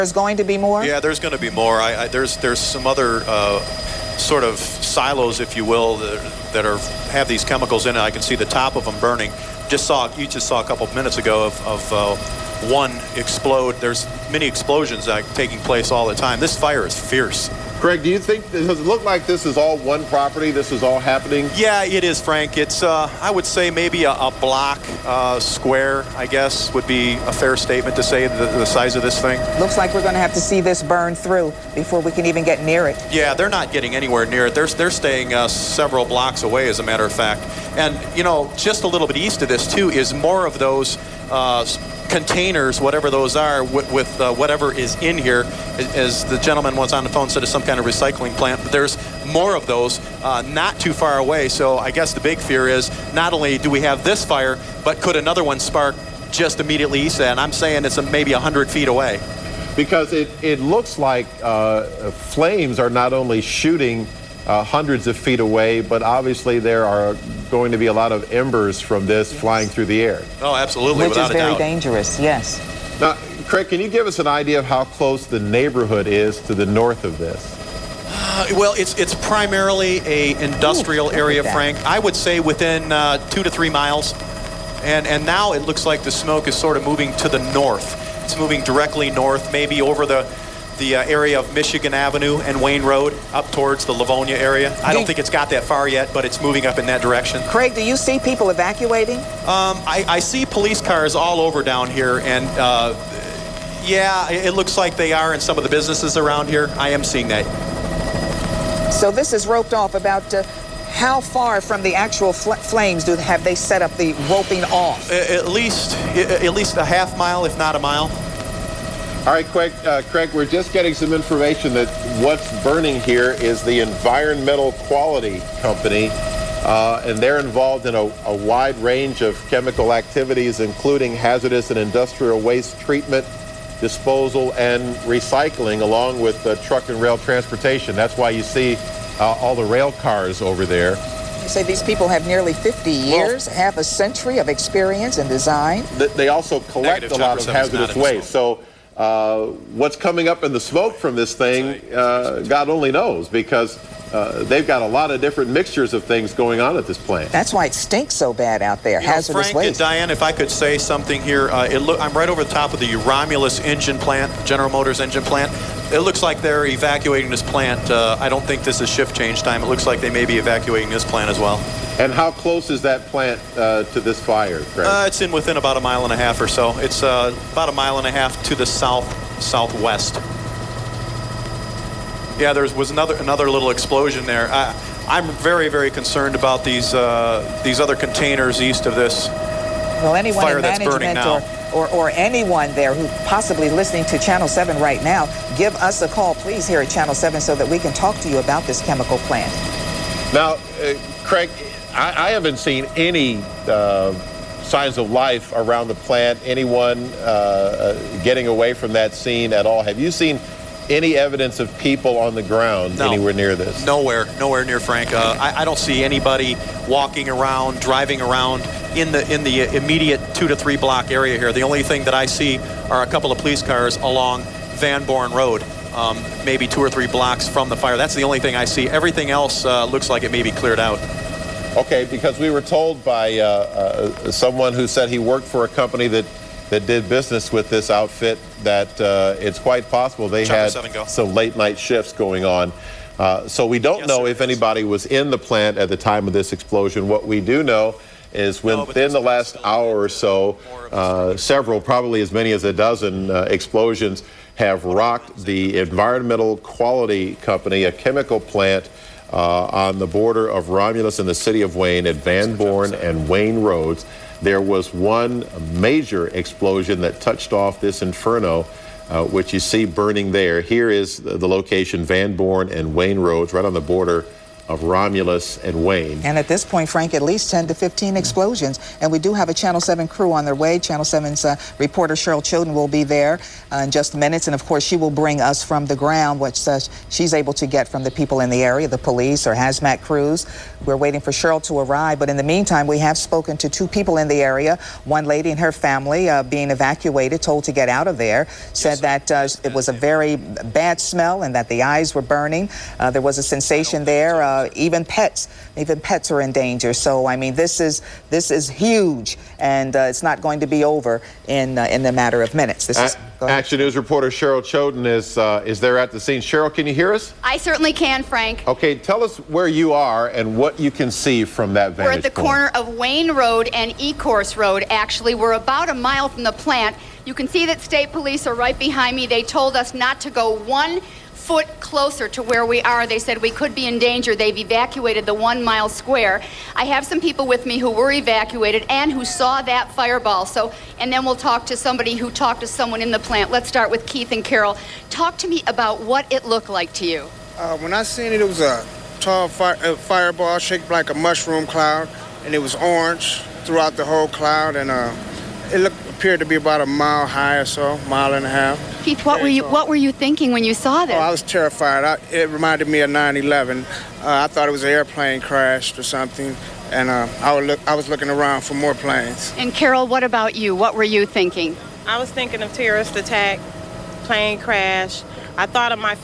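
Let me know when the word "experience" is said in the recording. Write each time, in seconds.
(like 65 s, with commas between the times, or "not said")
144 s.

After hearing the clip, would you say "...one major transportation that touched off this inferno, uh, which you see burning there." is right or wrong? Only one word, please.
wrong.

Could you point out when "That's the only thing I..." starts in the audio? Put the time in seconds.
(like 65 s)
227 s.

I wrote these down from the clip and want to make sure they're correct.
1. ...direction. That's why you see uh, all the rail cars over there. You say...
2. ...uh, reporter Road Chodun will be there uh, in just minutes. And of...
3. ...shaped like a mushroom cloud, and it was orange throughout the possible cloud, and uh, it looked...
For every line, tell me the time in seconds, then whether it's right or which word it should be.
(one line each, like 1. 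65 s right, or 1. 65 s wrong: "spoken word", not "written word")
1. 137 s wrong: "transportation", not "direction"
2. 281 s wrong: "Cheryl", not "Road"
3. 350 s wrong: "whole", not "possible".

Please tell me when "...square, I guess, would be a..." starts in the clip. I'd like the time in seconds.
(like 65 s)
25 s.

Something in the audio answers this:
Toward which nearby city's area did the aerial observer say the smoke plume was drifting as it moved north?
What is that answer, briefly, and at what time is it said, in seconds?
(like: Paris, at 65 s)
Livonia, at 93 s.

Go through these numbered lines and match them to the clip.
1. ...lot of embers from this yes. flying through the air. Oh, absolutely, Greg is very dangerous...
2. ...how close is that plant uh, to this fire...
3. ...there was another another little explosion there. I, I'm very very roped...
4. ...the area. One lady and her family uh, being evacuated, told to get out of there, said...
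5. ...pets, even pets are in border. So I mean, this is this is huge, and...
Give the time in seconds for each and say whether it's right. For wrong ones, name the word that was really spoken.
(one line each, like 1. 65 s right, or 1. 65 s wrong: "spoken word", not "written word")
1. 67 s wrong: "Which", not "Greg"
2. 172 s right
3. 182 s wrong: "concerned", not "roped"
4. 294 s right
5. 305 s wrong: "danger", not "border".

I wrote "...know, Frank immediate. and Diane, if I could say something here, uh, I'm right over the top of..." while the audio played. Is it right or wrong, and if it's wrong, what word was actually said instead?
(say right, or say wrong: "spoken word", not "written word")
wrong: "waste", not "immediate".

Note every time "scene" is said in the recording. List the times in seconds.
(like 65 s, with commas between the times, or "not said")
209 s, 316 s.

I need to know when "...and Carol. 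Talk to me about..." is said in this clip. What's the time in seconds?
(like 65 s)
344 s.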